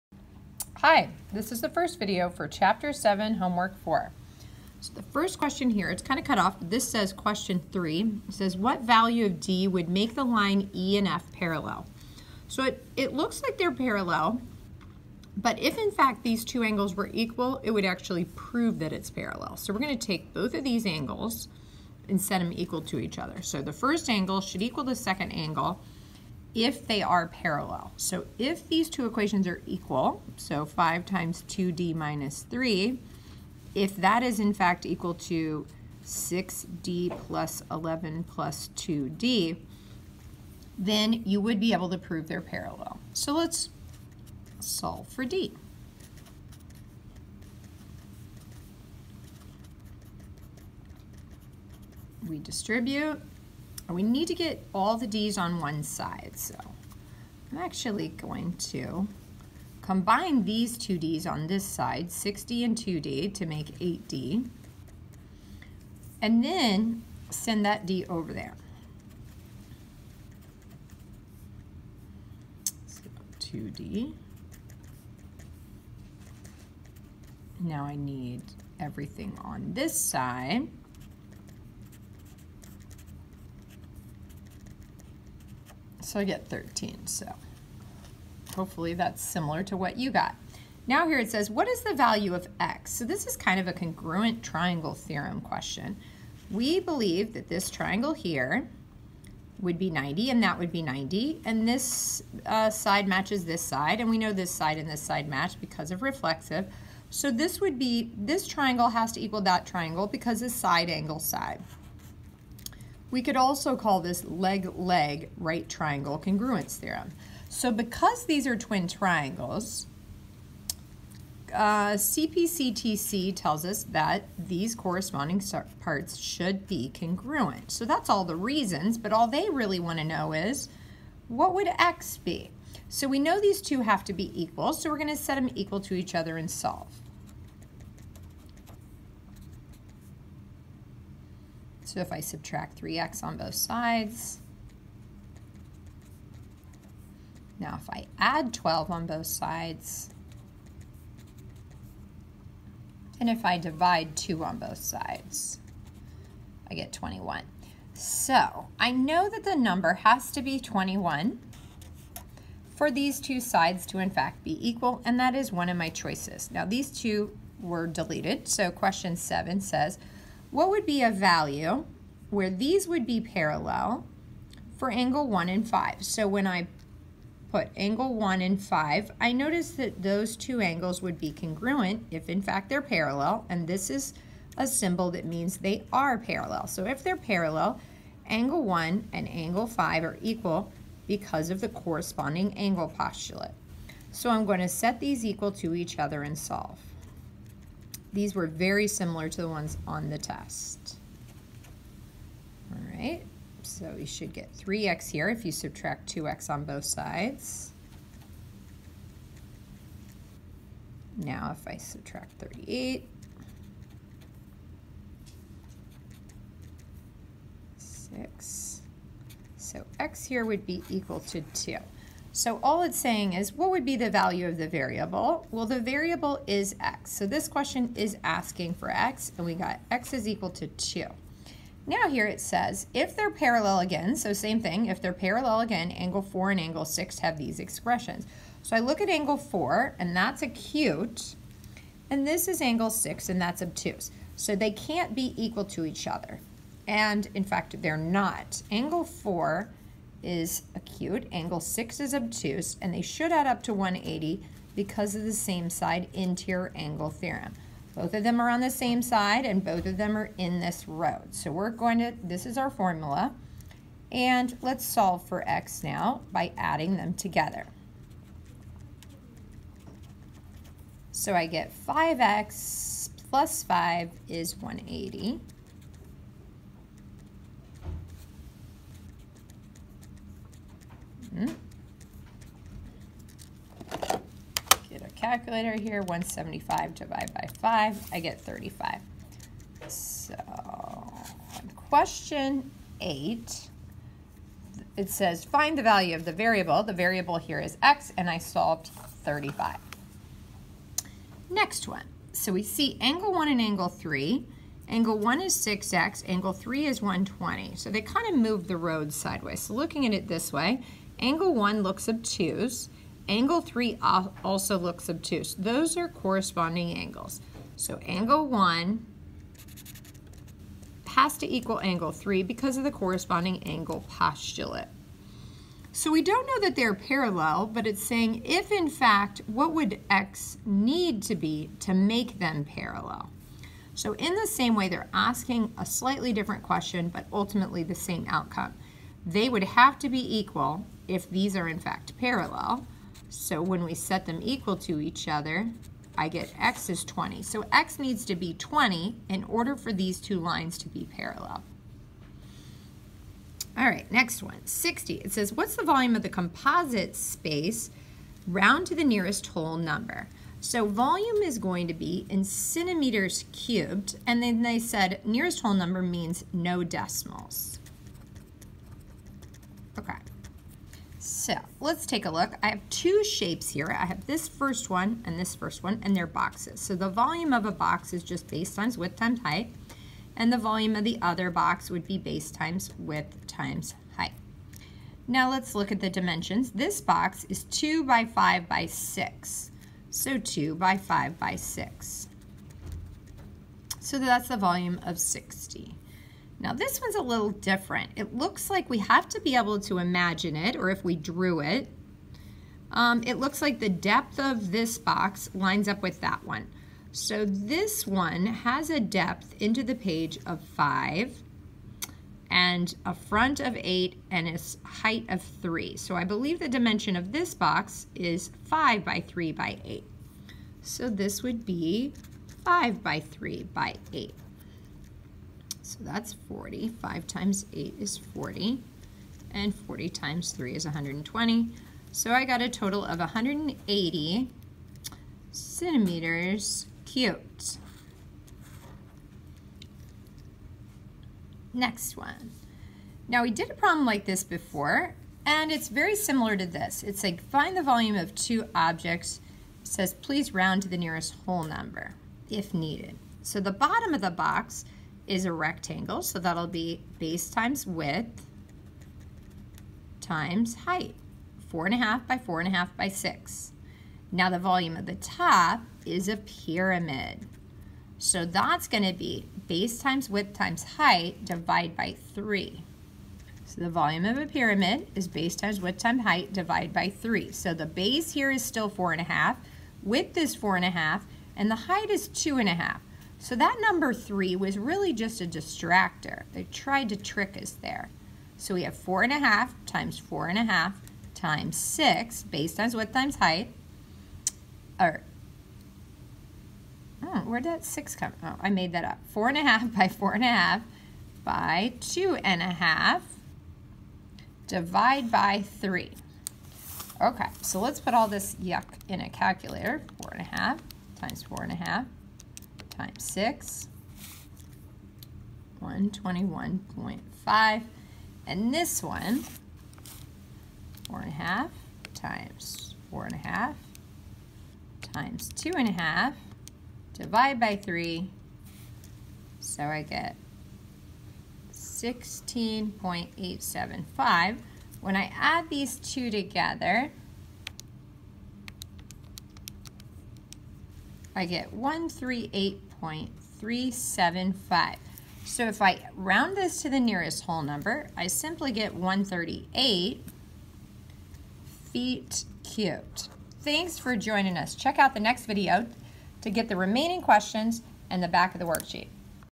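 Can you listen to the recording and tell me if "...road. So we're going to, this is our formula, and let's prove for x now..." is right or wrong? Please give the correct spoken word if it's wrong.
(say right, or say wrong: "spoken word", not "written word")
wrong: "solve", not "prove".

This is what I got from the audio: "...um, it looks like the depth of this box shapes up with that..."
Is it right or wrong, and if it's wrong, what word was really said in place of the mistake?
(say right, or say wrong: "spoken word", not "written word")
wrong: "lines", not "shapes".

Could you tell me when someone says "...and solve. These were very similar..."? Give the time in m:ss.
3:16.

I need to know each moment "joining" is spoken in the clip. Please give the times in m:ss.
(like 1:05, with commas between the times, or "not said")
9:14.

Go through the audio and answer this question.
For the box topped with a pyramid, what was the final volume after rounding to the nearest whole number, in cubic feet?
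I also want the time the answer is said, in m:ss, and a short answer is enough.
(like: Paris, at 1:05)
138, at 9:08.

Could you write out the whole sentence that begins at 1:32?
So this is kind of a congruent triangle theorem question.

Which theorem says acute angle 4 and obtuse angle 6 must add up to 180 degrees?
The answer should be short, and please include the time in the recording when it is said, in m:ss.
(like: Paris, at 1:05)
Same side interior angle theorem, at 4:15.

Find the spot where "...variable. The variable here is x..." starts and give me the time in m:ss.
4:56.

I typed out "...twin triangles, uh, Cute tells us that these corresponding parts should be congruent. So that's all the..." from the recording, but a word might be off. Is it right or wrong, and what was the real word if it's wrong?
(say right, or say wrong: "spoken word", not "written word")
wrong: "CPCTC", not "Cute".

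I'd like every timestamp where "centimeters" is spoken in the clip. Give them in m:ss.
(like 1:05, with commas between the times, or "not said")
6:02, 7:15.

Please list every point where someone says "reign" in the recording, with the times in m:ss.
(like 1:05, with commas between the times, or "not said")
not said.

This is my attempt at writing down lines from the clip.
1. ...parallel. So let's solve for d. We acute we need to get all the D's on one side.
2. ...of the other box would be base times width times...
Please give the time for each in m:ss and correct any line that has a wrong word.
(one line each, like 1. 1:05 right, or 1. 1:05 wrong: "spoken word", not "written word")
1. 0:42 wrong: "distribute", not "acute"
2. 6:20 right.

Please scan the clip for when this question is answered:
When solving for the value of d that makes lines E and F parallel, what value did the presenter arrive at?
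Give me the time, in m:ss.
1:26.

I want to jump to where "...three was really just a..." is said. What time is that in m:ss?
8:04.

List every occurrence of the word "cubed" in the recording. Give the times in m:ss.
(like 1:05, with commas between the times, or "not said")
6:03, 9:12.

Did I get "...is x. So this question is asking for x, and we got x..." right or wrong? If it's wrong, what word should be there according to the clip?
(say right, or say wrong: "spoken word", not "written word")
right.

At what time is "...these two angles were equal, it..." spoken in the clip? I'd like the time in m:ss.
0:16.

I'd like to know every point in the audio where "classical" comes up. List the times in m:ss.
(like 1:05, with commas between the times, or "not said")
not said.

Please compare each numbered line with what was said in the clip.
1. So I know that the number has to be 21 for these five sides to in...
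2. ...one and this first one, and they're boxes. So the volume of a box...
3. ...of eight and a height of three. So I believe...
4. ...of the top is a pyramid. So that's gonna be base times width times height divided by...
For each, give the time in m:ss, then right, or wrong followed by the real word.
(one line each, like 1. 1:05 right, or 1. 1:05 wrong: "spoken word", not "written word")
1. 2:37 wrong: "two", not "five"
2. 6:14 right
3. 6:53 right
4. 7:44 right.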